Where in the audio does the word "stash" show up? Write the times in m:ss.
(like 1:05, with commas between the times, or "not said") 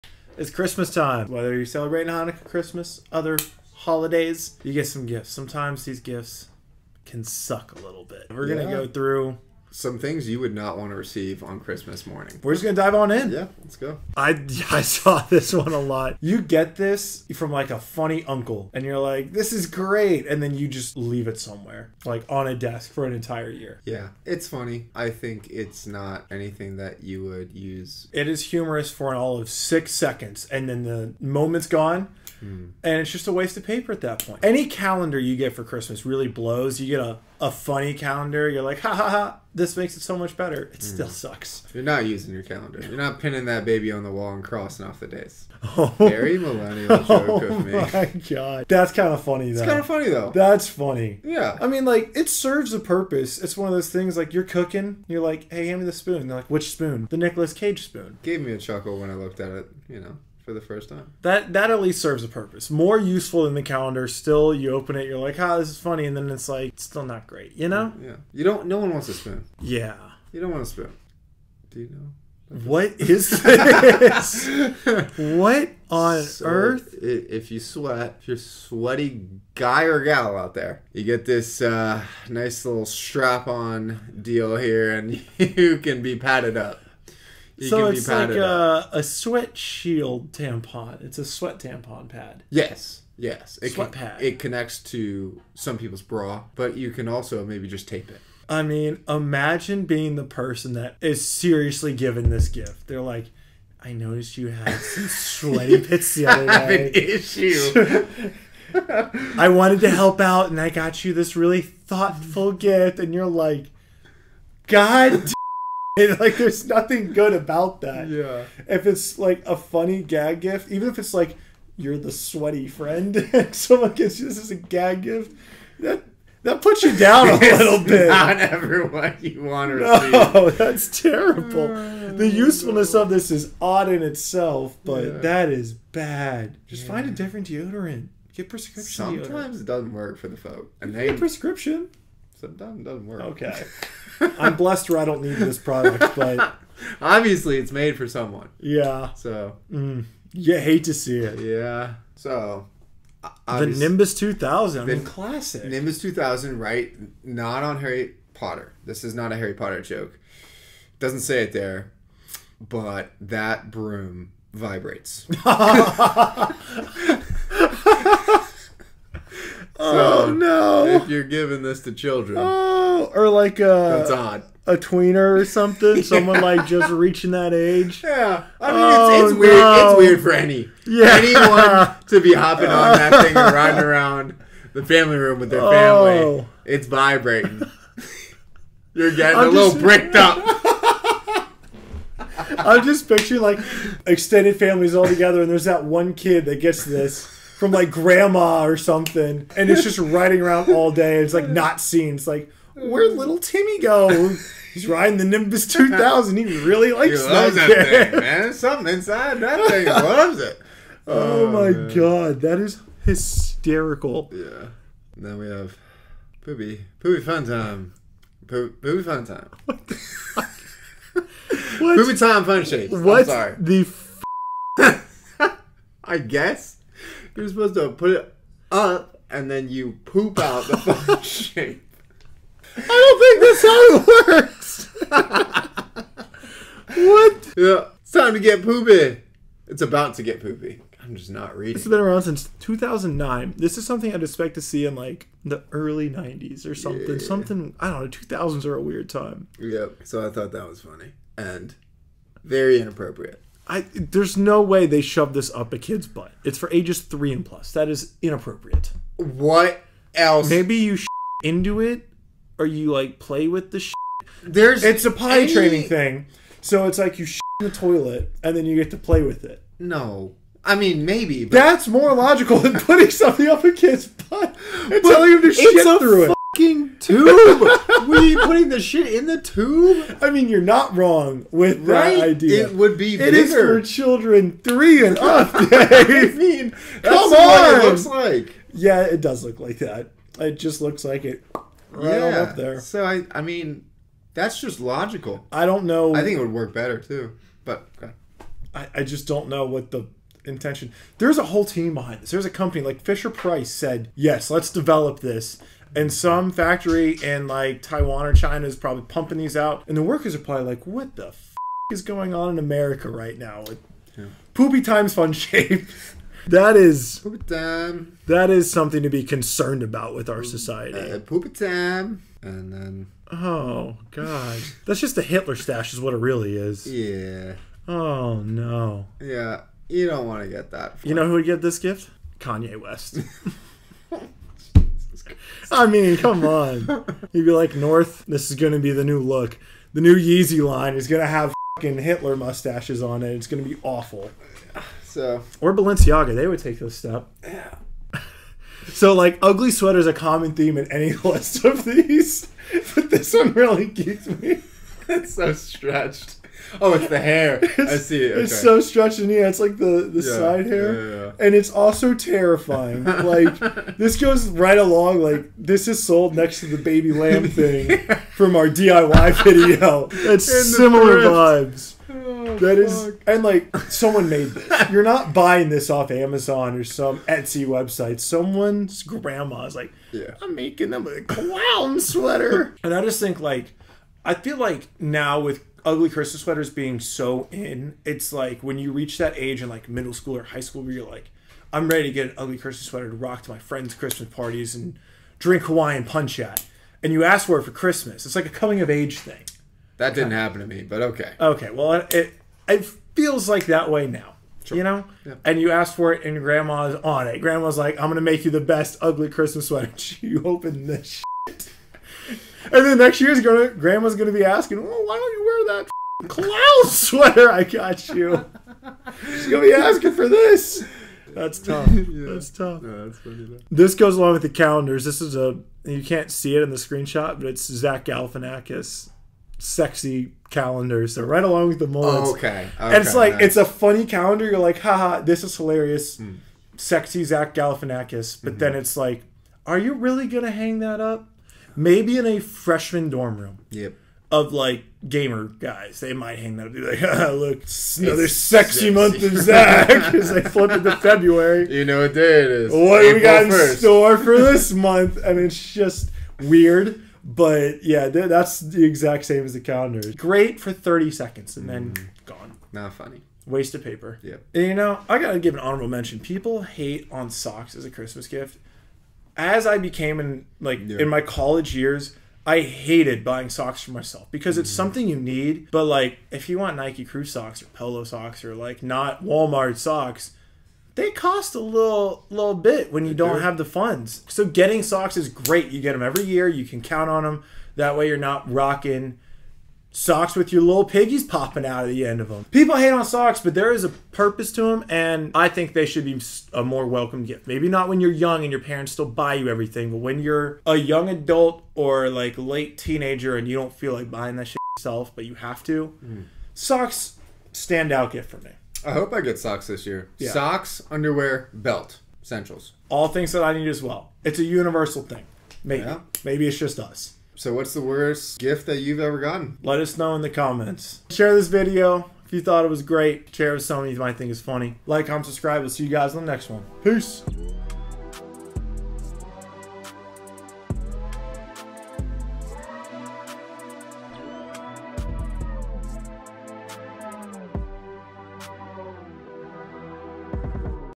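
5:25.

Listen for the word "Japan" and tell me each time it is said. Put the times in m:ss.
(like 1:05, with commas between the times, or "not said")
not said.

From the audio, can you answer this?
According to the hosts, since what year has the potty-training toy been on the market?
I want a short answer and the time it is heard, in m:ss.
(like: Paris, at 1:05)
2009, at 4:02.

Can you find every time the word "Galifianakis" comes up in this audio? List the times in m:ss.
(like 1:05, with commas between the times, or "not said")
7:08, 7:17.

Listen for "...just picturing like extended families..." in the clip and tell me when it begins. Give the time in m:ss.
3:12.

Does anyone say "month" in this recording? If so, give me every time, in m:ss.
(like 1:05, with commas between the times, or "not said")
7:28, 7:34.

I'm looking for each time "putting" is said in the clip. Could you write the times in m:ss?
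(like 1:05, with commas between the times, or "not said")
4:32, 4:38.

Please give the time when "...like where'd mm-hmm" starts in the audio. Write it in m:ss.
3:22.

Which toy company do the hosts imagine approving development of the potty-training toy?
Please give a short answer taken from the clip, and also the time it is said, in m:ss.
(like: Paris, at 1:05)
Fisher Price, at 5:03.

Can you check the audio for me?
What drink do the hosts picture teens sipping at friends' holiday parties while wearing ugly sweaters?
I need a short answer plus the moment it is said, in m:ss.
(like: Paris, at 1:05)
Hawaiian punch, at 6:35.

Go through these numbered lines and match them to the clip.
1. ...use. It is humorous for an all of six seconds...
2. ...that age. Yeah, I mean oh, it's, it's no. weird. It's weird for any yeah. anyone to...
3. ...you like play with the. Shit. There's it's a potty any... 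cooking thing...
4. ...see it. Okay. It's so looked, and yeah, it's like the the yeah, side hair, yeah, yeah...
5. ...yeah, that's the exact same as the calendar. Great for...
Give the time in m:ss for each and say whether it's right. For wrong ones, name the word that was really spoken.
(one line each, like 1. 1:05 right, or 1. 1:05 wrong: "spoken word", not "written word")
1. 0:27 right
2. 2:57 right
3. 4:22 wrong: "training", not "cooking"
4. 5:57 wrong: "stretched", not "looked"
5. 7:37 right.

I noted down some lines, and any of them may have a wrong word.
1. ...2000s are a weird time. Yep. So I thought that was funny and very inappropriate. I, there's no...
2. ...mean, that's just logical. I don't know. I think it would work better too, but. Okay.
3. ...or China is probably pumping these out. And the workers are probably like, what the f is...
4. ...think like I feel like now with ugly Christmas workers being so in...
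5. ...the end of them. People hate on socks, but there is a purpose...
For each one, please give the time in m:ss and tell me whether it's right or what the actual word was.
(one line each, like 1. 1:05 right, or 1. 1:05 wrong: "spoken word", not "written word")
1. 4:08 right
2. 4:53 right
3. 5:08 right
4. 6:23 wrong: "sweaters", not "workers"
5. 8:11 right.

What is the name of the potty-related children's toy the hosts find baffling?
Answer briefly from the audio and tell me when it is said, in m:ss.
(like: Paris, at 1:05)
Poopy Time Fun Shape, at 3:41.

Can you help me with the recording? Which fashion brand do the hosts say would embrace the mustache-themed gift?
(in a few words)
Balenciaga.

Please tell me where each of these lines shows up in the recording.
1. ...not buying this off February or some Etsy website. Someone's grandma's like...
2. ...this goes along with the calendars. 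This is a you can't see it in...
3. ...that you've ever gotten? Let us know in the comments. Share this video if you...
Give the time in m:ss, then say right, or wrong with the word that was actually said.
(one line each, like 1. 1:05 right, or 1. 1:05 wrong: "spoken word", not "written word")
1. 6:15 wrong: "Amazon", not "February"
2. 7:03 right
3. 8:38 right.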